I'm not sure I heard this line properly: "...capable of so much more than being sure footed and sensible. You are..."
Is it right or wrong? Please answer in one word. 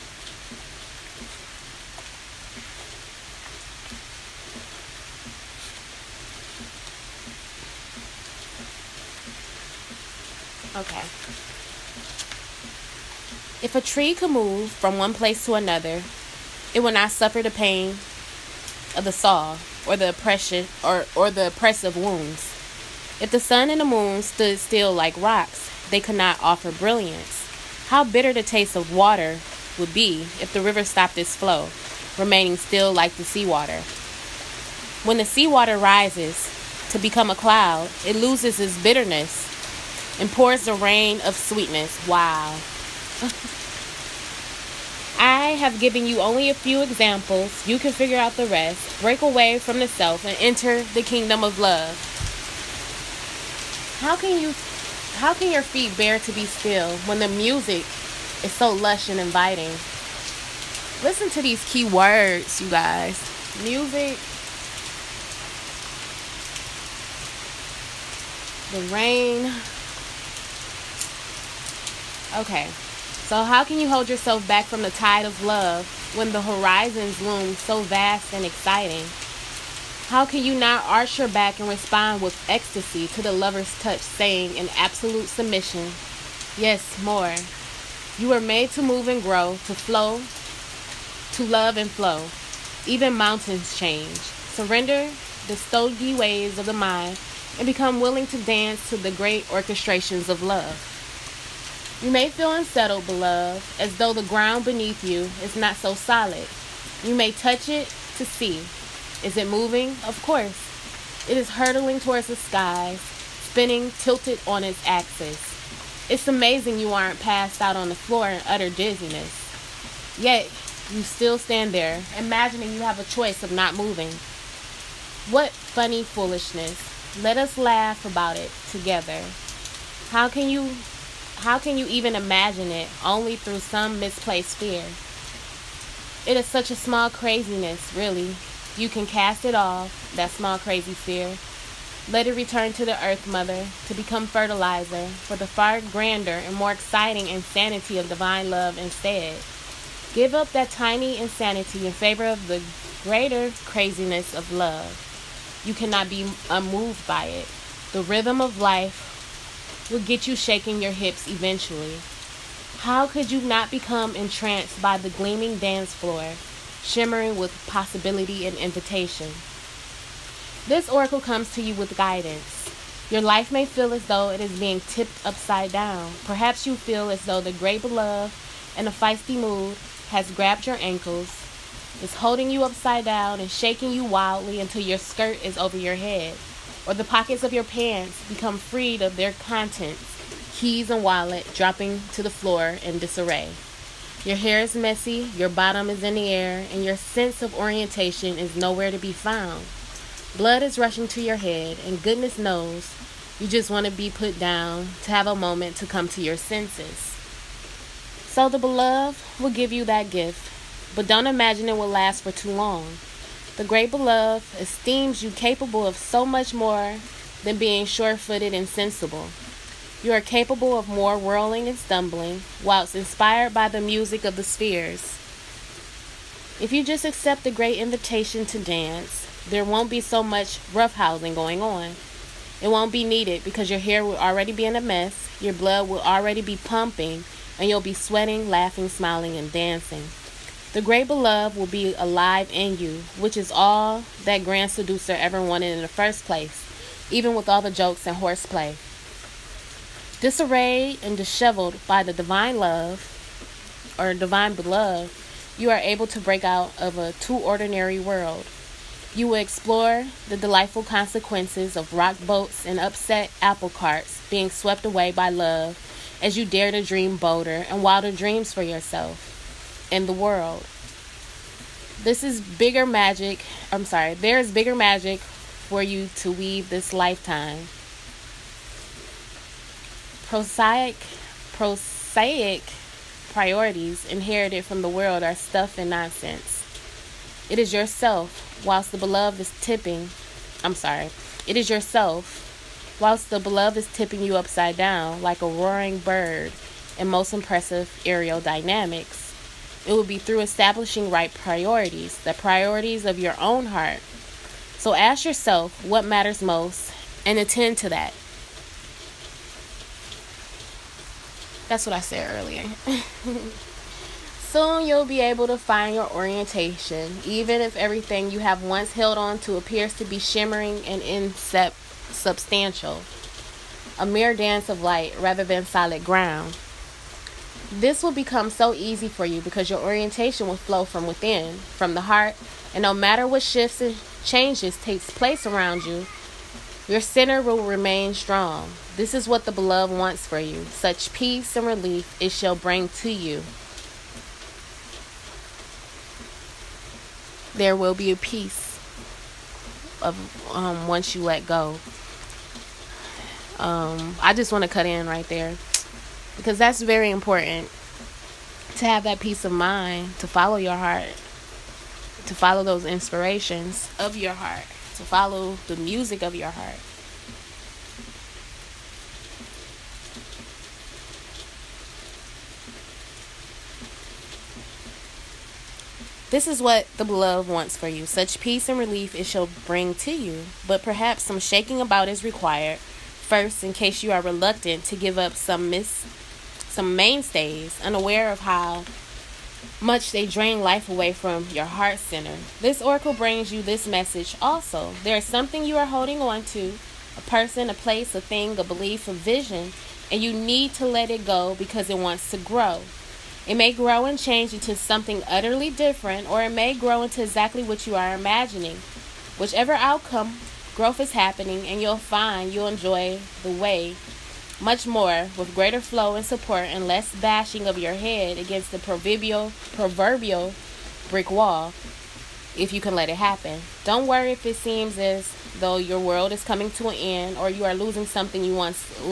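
right.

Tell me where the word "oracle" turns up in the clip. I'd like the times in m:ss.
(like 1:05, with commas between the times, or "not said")
2:50, 6:32.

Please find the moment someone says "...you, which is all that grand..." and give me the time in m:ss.
4:02.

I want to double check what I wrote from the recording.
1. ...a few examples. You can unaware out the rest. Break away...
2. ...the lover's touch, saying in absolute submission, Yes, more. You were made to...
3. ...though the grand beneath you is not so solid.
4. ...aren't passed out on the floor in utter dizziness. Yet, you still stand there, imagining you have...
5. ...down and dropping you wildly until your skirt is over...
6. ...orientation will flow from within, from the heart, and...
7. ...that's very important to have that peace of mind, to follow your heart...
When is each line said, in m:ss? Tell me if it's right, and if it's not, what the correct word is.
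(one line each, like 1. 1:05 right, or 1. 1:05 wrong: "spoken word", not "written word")
1. 0:46 wrong: "figure", not "unaware"
2. 1:23 right
3. 1:43 wrong: "ground", not "grand"
4. 1:56 right
5. 3:03 wrong: "shaking", not "dropping"
6. 5:29 right
7. 5:56 right.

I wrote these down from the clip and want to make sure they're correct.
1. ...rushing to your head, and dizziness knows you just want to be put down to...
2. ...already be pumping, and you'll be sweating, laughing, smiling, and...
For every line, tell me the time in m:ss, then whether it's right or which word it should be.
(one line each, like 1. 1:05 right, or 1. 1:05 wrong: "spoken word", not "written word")
1. 3:20 wrong: "goodness", not "dizziness"
2. 3:56 right.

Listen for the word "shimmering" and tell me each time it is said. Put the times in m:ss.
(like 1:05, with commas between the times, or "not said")
2:46, 5:20.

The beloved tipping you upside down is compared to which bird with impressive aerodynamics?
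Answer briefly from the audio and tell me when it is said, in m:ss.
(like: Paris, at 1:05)
roaring bird, at 4:55.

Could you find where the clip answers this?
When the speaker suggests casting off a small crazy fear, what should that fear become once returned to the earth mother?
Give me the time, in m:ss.
2:24.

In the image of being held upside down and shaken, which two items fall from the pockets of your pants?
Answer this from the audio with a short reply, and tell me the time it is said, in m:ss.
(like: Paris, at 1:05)
keys and wallet, at 3:10.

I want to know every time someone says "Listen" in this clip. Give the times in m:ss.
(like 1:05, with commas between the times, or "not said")
1:01.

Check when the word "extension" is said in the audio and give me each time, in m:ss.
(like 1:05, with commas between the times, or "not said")
not said.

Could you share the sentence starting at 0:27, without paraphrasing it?
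How bitter the taste of water would be if the river stopped its flow, remaining still like the seawater.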